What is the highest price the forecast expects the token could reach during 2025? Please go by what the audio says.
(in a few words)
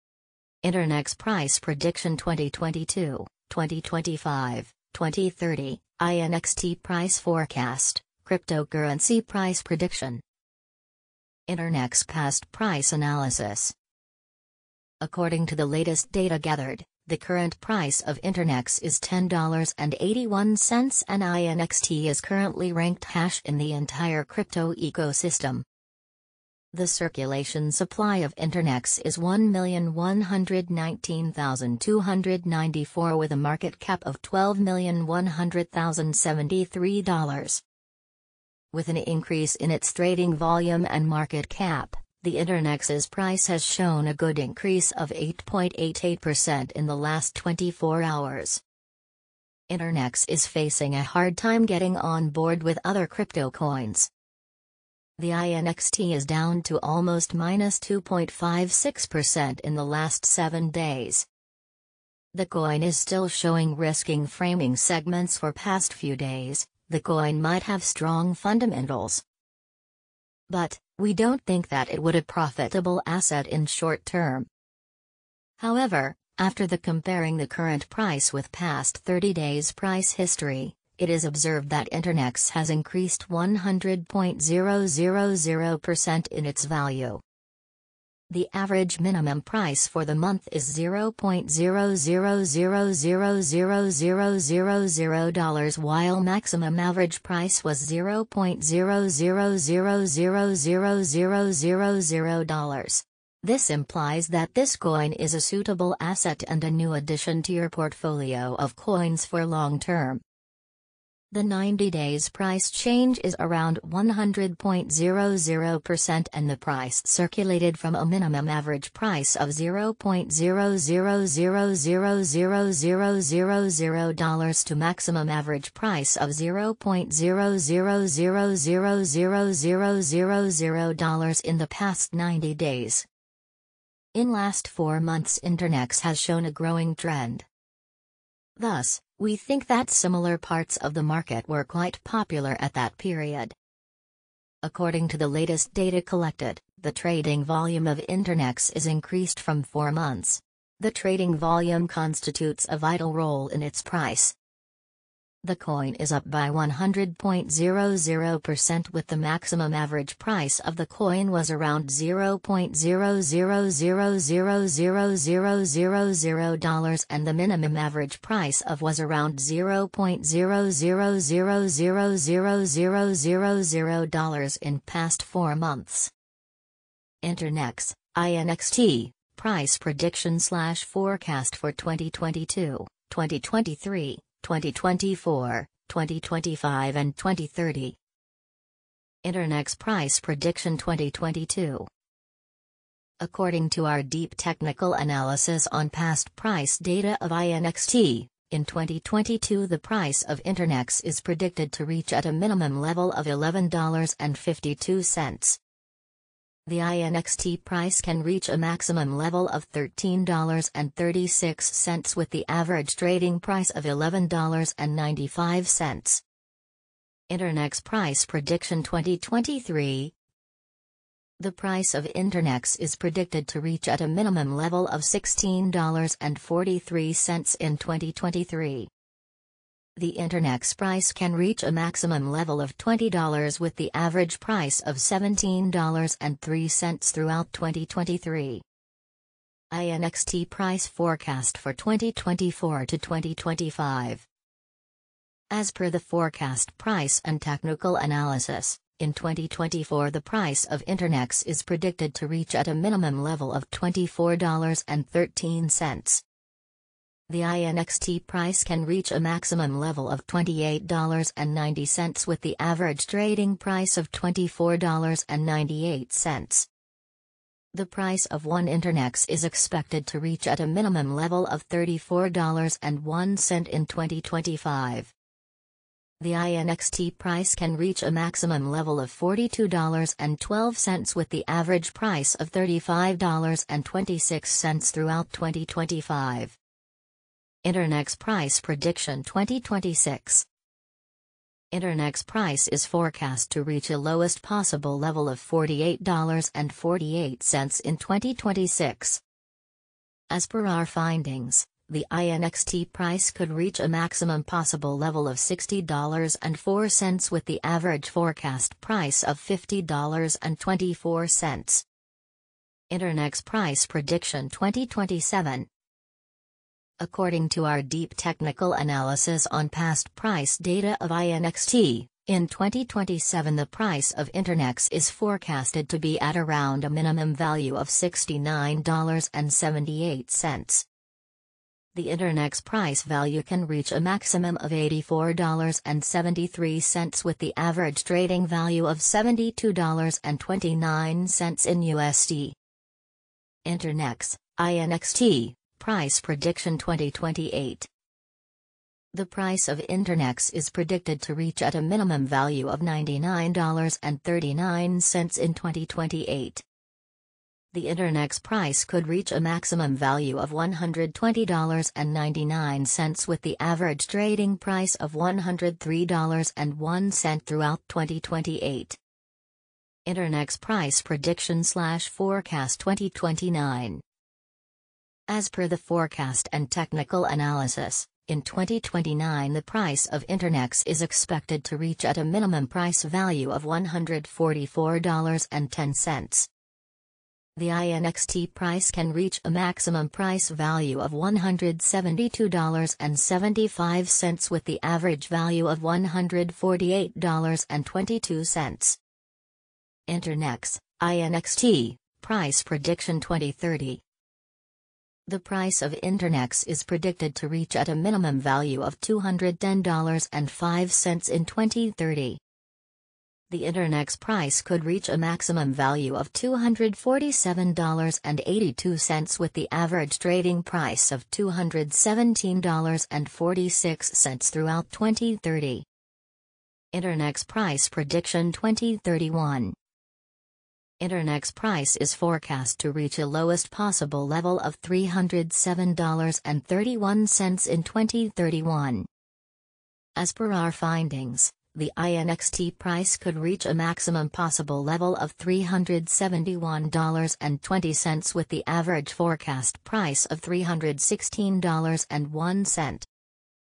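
$42.12.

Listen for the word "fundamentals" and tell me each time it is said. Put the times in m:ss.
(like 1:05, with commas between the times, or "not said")
1:08.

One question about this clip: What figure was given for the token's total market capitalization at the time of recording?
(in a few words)
$12,100,073.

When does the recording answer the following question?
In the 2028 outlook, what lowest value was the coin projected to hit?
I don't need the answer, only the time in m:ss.
5:52.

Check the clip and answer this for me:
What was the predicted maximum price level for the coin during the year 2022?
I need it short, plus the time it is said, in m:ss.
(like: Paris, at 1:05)
$13.36, at 3:29.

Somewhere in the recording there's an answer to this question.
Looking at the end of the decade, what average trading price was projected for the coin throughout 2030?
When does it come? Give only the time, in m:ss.
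7:01.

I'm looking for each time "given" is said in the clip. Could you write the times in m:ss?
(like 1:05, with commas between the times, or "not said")
not said.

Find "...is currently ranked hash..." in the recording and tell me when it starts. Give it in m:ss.
0:22.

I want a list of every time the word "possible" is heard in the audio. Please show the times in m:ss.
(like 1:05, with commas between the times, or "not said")
4:54, 5:04, 7:13, 7:24.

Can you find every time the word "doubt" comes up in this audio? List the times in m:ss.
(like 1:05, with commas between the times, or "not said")
not said.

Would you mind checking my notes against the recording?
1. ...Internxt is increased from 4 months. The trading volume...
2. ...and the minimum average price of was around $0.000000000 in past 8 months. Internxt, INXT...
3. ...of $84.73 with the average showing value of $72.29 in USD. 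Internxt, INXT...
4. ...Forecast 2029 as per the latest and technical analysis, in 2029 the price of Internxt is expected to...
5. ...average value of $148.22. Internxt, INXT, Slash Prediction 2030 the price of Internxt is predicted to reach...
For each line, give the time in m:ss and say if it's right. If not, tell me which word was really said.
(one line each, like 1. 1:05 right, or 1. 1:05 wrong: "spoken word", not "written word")
1. 2:28 right
2. 2:47 wrong: "4", not "8"
3. 5:34 wrong: "trading", not "showing"
4. 6:12 wrong: "forecast", not "latest"
5. 6:34 wrong: "Price", not "Slash".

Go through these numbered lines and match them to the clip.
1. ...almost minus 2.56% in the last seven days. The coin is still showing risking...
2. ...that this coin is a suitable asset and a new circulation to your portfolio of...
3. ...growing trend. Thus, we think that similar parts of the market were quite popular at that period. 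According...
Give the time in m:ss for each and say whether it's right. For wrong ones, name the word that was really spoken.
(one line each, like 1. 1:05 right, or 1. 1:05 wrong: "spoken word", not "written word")
1. 0:56 right
2. 1:44 wrong: "addition", not "circulation"
3. 2:16 right.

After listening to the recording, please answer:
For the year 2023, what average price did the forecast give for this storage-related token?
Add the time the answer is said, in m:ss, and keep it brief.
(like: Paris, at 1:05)
$17.03, at 3:54.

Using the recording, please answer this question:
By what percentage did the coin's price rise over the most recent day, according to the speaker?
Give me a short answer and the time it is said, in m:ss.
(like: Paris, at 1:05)
8.88%, at 0:45.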